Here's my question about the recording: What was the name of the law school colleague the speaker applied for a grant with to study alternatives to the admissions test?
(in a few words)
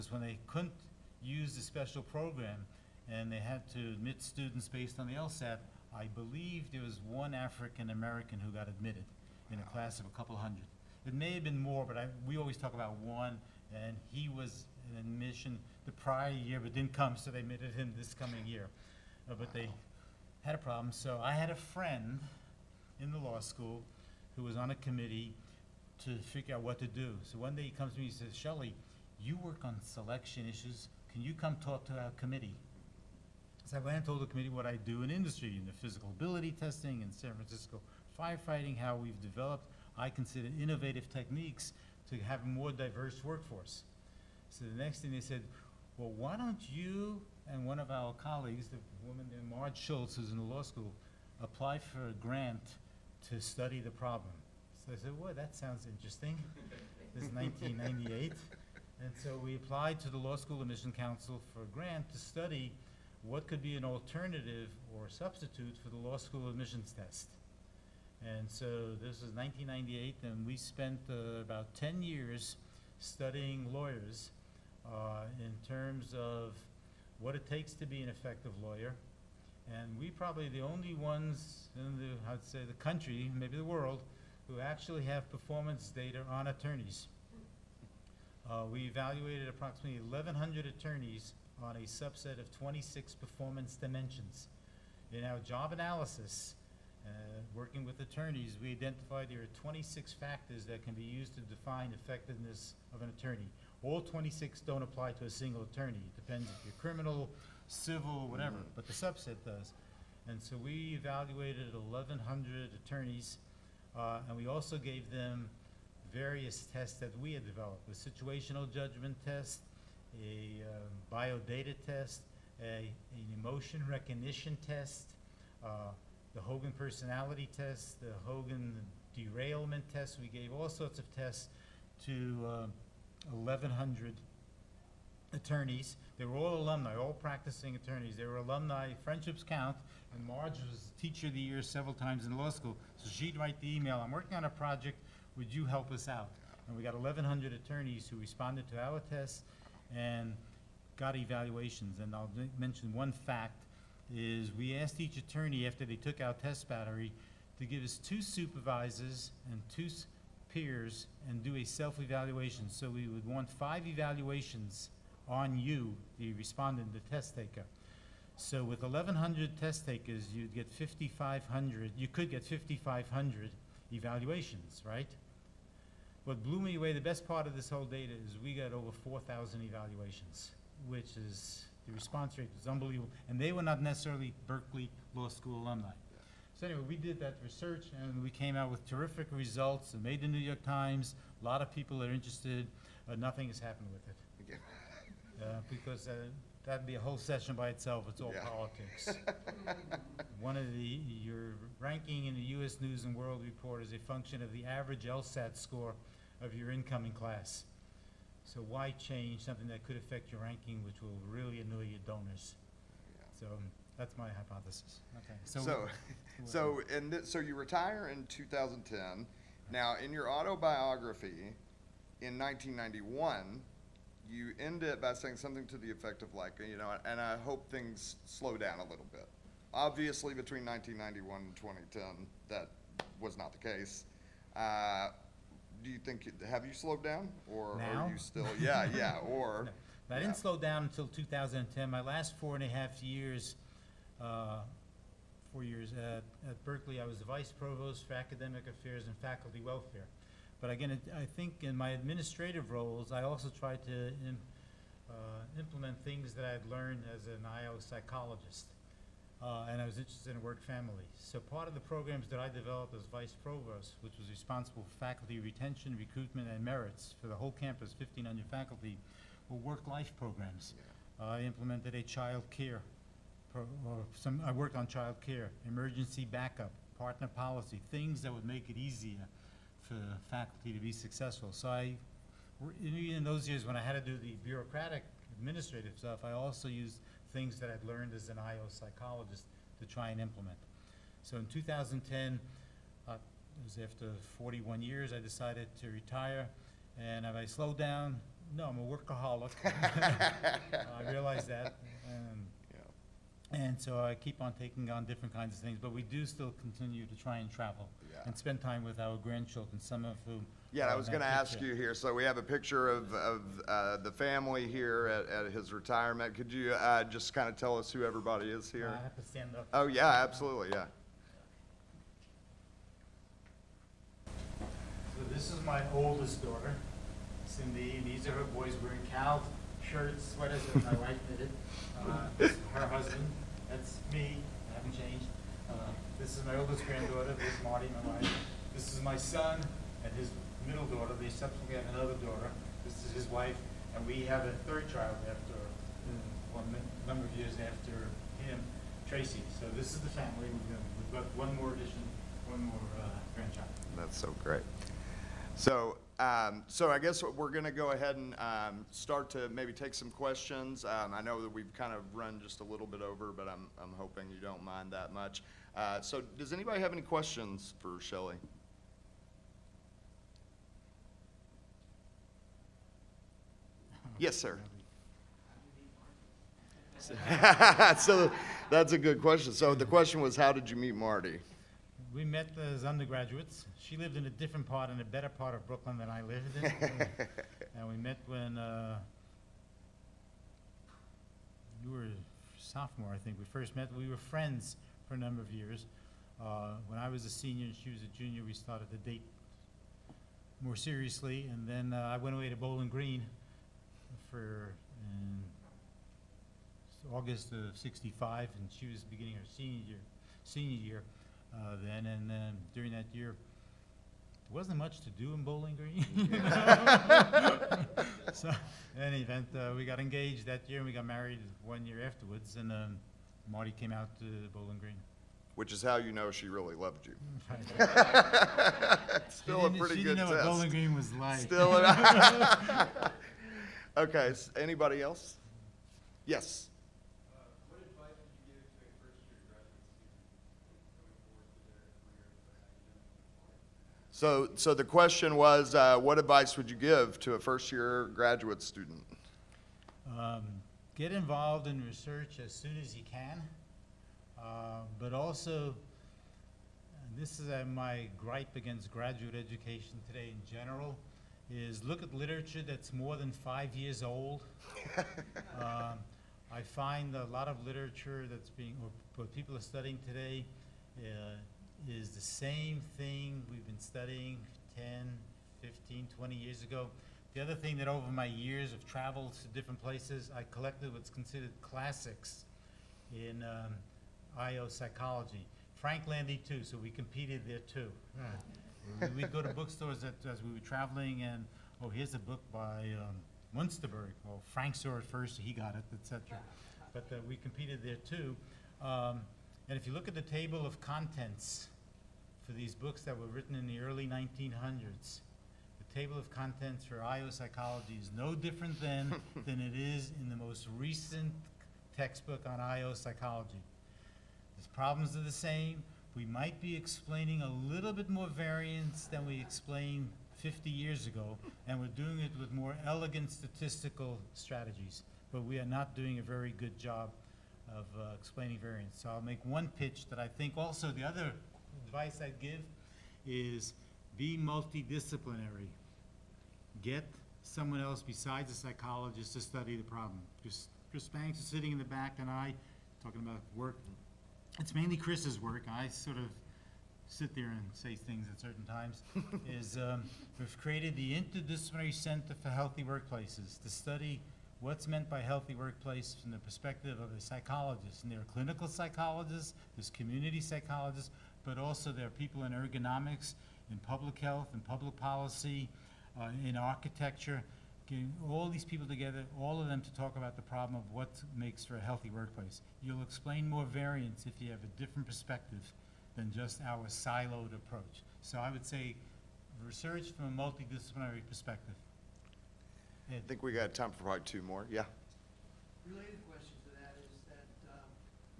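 Marge Shultz.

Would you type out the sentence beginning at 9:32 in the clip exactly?
You'll explain more variance if you have a different perspective than just our siloed approach.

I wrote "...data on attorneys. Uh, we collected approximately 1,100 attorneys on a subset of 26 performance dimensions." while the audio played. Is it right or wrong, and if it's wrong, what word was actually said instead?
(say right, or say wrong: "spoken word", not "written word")
wrong: "evaluated", not "collected".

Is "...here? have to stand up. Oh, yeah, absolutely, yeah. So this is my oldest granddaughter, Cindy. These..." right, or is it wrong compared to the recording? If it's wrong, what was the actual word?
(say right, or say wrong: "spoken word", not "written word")
wrong: "daughter", not "granddaughter".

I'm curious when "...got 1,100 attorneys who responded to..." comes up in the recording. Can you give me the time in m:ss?
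2:26.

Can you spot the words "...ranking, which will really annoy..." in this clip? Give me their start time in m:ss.
3:30.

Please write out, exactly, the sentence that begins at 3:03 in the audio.
And they were not necessarily Berkeley Law School alumni.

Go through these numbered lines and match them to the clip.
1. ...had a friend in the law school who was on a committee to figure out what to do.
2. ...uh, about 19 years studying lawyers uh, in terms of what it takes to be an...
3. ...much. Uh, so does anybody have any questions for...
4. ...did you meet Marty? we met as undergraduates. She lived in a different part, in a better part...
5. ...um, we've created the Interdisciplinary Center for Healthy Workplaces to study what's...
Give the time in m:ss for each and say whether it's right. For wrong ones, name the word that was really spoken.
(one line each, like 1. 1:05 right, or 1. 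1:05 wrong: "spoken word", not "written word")
1. 0:21 right
2. 1:11 wrong: "10", not "19"
3. 6:05 right
4. 6:20 right
5. 9:09 right.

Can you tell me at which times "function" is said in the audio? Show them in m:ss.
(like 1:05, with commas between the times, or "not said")
3:23.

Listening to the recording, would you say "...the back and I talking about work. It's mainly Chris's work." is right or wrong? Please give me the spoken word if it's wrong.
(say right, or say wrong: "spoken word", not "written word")
right.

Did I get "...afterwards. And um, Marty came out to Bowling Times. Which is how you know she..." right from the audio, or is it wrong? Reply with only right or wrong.
wrong.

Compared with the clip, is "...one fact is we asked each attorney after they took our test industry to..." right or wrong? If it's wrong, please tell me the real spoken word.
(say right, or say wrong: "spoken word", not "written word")
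wrong: "battery", not "industry".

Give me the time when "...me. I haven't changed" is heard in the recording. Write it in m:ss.
5:34.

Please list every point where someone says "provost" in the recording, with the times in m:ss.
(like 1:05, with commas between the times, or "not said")
4:07, 4:23.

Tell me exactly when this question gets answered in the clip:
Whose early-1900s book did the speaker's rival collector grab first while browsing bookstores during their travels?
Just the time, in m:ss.
8:13.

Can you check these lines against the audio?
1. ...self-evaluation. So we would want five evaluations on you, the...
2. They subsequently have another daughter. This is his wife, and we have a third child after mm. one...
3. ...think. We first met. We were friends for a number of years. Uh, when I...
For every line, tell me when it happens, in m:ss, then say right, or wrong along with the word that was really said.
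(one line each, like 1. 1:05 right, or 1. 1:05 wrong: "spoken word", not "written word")
1. 2:41 right
2. 5:41 right
3. 6:33 right.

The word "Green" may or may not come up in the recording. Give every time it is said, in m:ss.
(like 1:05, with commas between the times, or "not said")
6:42, 6:55, 7:04, 7:10.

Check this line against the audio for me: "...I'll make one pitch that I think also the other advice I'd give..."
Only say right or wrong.
right.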